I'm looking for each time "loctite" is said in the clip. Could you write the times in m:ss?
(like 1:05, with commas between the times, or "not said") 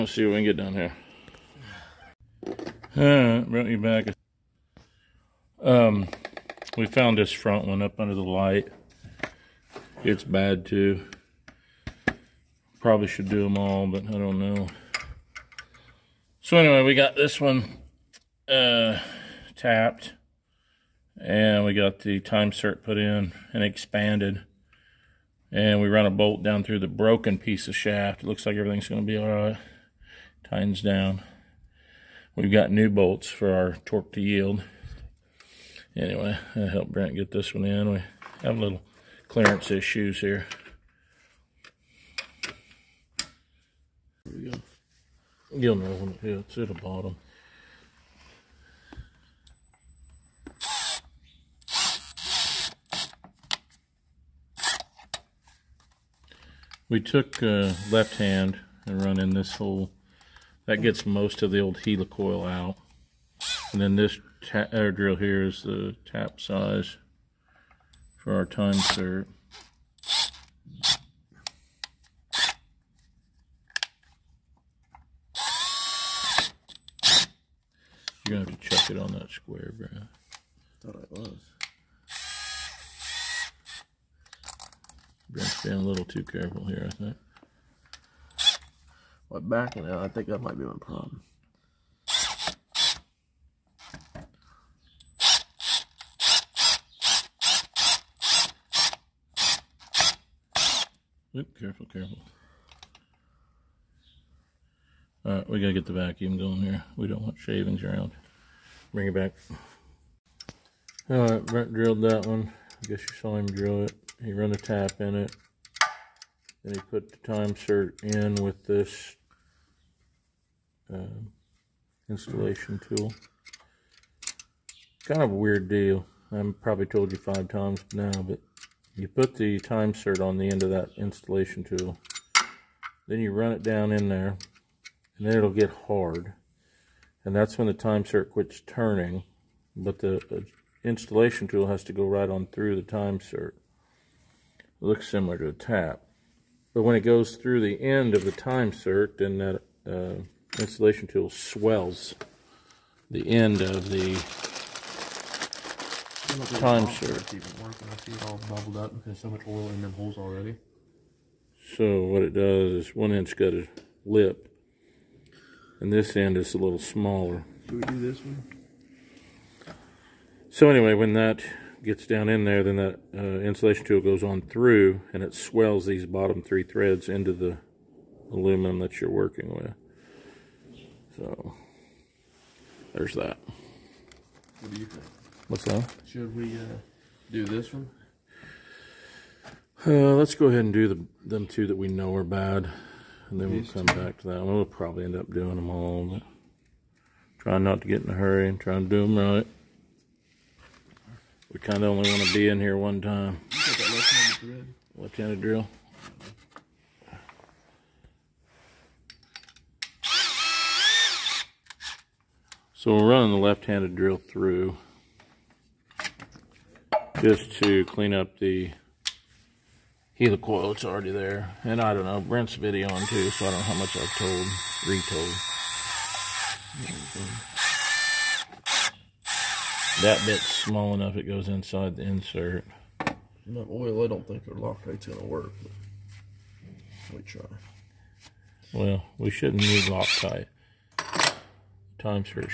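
3:54, 3:59.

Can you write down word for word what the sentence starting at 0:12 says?
Probably should do them all, but I don't know.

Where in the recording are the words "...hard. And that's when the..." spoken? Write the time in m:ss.
2:15.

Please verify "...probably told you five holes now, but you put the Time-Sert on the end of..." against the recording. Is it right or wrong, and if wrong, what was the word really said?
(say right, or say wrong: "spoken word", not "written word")
wrong: "times", not "holes".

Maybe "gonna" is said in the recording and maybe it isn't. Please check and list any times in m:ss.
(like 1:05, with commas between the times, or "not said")
1:18, 3:55.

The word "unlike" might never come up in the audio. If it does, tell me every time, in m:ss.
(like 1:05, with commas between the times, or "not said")
not said.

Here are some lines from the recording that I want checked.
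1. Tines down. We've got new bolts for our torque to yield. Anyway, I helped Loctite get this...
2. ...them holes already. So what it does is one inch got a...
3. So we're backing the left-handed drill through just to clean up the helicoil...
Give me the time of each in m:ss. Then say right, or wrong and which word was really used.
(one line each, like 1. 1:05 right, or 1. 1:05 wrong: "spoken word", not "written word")
1. 0:30 wrong: "Brent", not "Loctite"
2. 2:39 right
3. 3:32 wrong: "running", not "backing".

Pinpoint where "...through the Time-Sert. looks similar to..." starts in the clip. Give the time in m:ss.
2:22.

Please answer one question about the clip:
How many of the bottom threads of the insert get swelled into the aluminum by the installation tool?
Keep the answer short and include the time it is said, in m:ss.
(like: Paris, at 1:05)
3, at 2:56.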